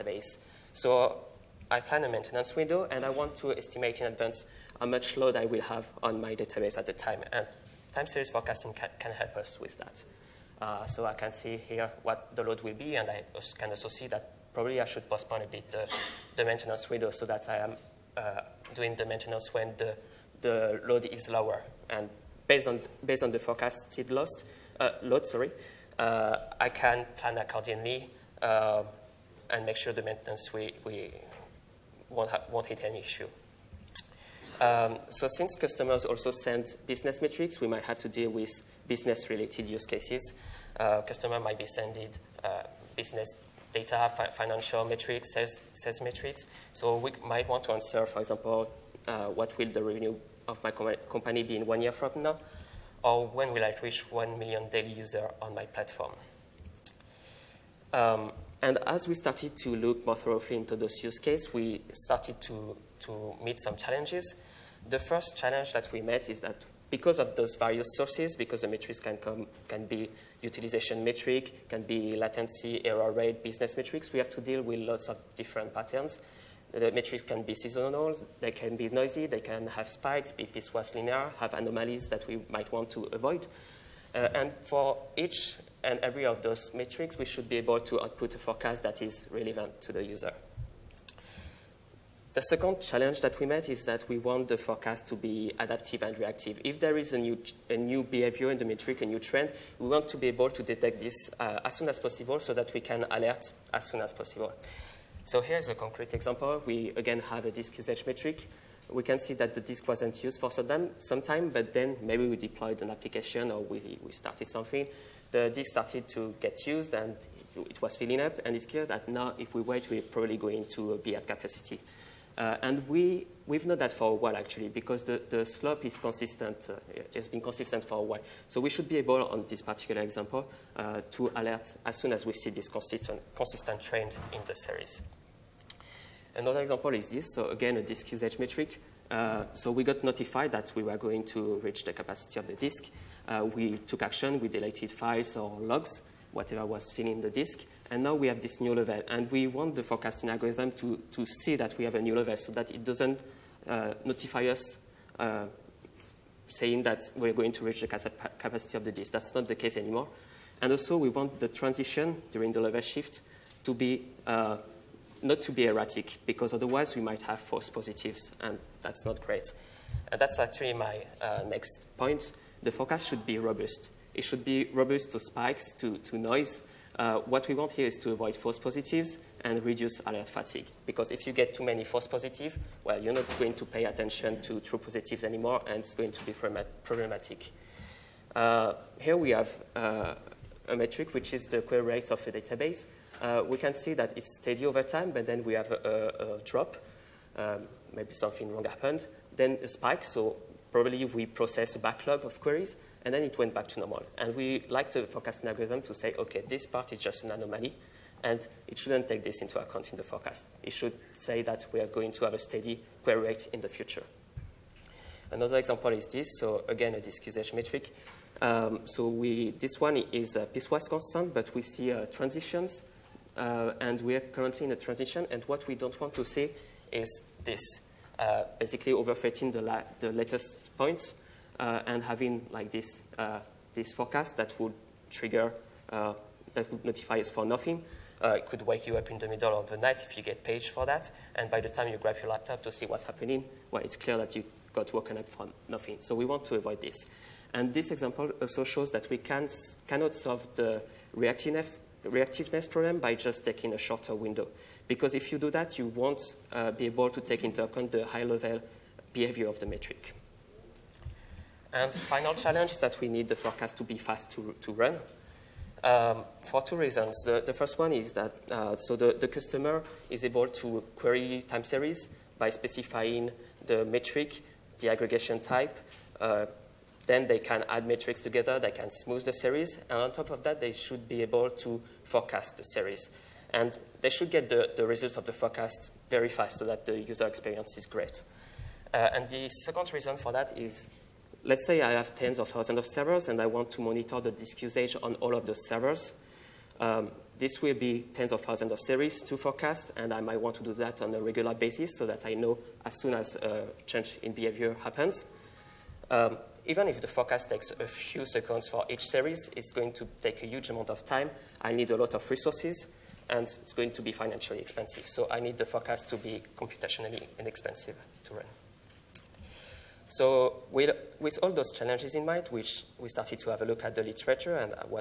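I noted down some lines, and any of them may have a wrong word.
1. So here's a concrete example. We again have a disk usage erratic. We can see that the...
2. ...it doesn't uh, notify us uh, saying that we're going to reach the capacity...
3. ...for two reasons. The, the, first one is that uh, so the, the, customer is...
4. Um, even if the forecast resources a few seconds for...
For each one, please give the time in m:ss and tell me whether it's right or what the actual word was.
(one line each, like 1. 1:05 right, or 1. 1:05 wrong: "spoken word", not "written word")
1. 1:45 wrong: "metric", not "erratic"
2. 2:32 right
3. 4:26 right
4. 5:06 wrong: "takes", not "resources".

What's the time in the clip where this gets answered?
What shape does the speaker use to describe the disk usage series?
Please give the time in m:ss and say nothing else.
3:40.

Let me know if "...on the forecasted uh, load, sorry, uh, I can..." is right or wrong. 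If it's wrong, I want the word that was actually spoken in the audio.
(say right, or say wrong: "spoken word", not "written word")
right.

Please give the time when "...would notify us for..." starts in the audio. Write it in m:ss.
3:56.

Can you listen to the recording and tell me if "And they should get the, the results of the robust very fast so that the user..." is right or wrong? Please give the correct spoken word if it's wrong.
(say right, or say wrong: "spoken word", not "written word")
wrong: "forecast", not "robust".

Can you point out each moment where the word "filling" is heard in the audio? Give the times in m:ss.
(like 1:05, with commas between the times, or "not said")
1:57, 2:26.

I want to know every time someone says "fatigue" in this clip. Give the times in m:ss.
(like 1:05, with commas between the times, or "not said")
3:00.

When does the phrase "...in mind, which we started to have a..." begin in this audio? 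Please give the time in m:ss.
5:22.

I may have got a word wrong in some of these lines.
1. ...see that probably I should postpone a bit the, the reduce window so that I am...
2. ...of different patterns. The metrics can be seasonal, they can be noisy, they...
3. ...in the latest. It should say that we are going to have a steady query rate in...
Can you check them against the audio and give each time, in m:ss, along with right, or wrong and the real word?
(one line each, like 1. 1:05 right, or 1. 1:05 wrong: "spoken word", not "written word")
1. 0:13 wrong: "maintenance", not "reduce"
2. 1:15 right
3. 3:29 wrong: "forecast", not "latest".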